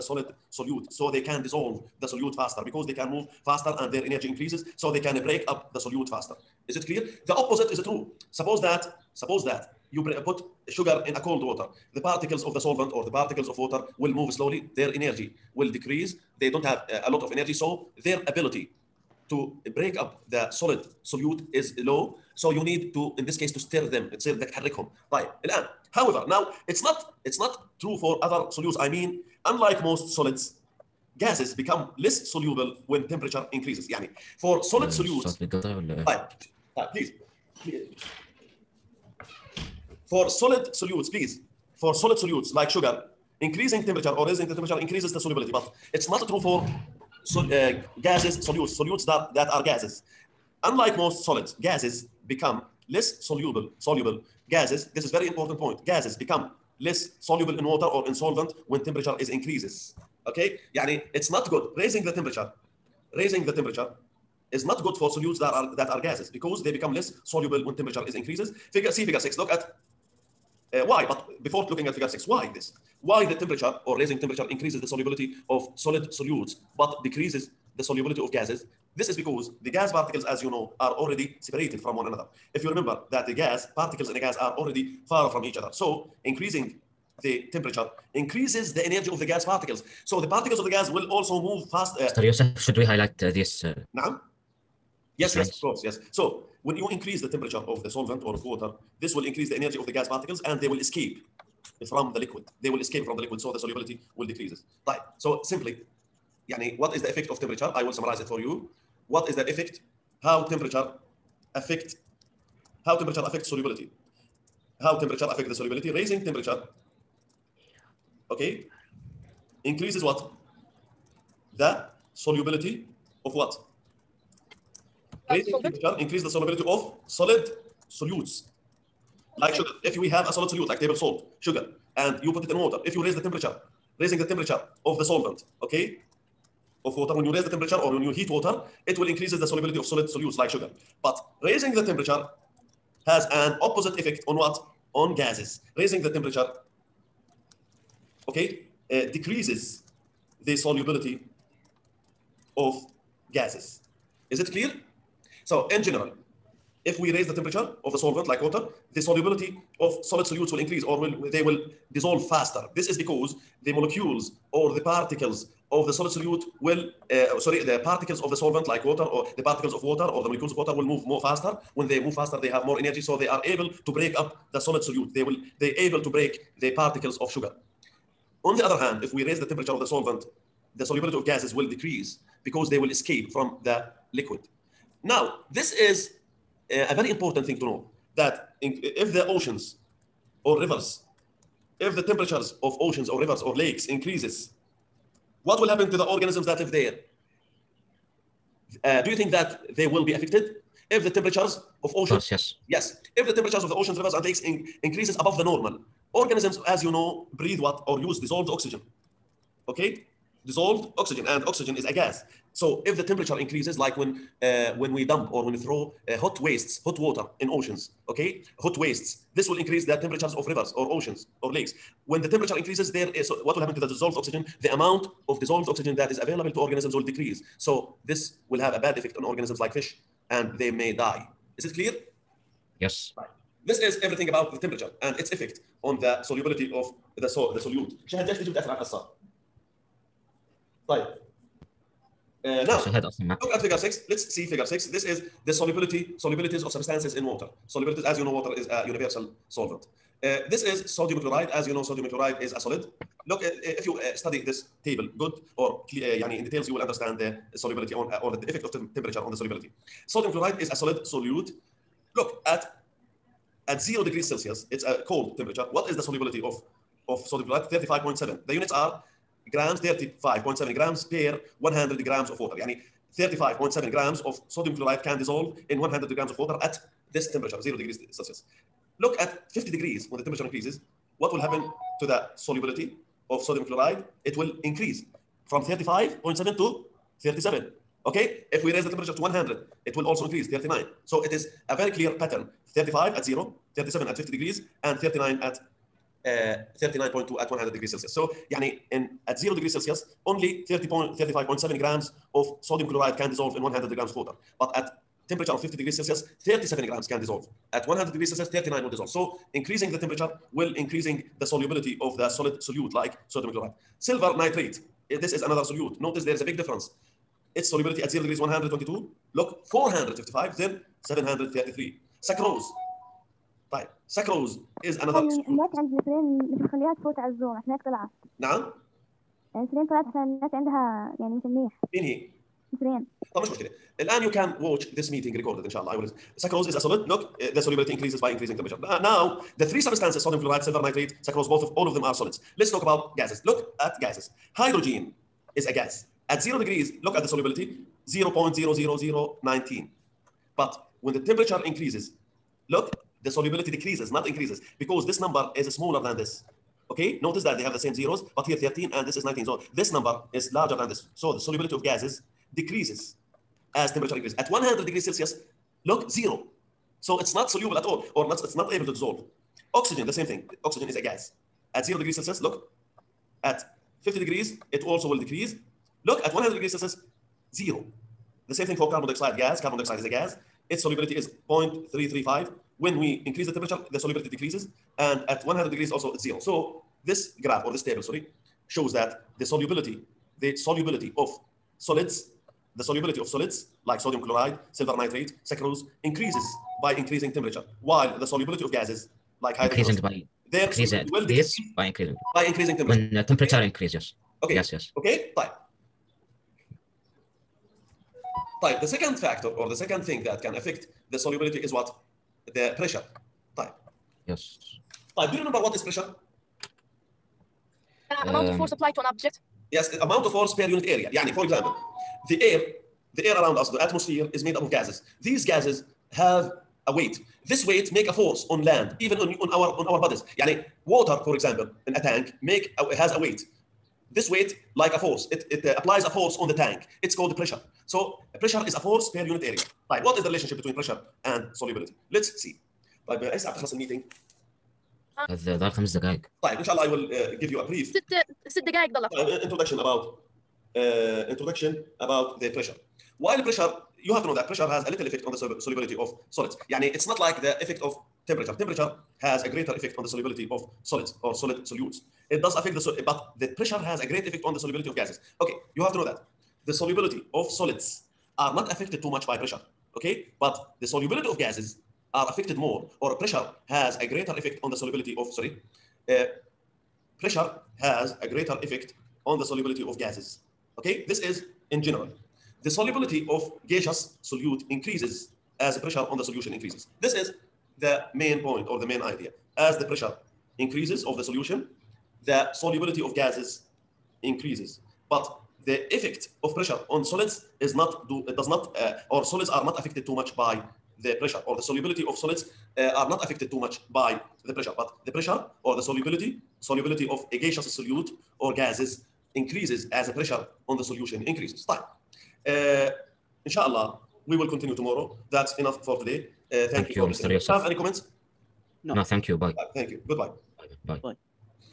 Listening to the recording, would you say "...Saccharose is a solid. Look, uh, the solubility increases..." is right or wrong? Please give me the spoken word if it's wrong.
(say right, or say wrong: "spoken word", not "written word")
right.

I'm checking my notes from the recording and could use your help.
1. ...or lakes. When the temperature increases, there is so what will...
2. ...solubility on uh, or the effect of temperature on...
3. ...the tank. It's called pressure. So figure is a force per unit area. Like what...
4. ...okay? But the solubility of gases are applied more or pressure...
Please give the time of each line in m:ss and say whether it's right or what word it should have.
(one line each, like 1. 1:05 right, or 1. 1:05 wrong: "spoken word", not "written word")
1. 3:41 right
2. 4:17 right
3. 7:16 wrong: "pressure", not "figure"
4. 7:49 wrong: "affected", not "applied".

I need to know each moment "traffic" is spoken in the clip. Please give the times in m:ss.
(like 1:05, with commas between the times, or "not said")
not said.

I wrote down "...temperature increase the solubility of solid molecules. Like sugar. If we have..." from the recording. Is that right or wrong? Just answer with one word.
wrong.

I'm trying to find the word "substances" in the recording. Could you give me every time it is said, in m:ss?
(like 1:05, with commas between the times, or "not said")
4:06, 5:39.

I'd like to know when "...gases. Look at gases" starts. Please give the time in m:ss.
5:43.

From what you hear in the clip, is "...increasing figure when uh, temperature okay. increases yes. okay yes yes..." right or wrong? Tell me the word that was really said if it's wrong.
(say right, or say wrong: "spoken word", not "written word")
wrong: "temperature", not "figure".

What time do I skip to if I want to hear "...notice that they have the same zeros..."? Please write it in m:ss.
5:57.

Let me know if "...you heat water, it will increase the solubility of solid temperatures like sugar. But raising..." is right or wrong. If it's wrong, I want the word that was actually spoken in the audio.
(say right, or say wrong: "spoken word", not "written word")
wrong: "solutes", not "temperatures".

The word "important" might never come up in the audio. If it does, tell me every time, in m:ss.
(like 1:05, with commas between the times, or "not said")
0:55, 3:07.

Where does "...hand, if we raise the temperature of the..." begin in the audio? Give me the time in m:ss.
2:58.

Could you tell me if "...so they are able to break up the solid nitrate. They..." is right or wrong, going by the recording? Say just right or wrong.
wrong.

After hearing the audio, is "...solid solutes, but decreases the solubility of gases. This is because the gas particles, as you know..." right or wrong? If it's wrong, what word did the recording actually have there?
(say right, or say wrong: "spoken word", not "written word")
right.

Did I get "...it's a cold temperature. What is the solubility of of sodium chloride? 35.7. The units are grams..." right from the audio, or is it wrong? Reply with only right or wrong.
right.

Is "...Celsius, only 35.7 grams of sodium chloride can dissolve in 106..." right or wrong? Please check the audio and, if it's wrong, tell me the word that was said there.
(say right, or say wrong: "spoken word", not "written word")
wrong: "100", not "106".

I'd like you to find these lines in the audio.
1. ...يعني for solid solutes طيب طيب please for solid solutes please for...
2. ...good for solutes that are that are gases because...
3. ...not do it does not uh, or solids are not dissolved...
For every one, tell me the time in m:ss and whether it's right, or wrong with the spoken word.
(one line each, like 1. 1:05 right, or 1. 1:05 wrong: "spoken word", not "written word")
1. 0:33 right
2. 1:04 right
3. 8:17 wrong: "affected", not "dissolved".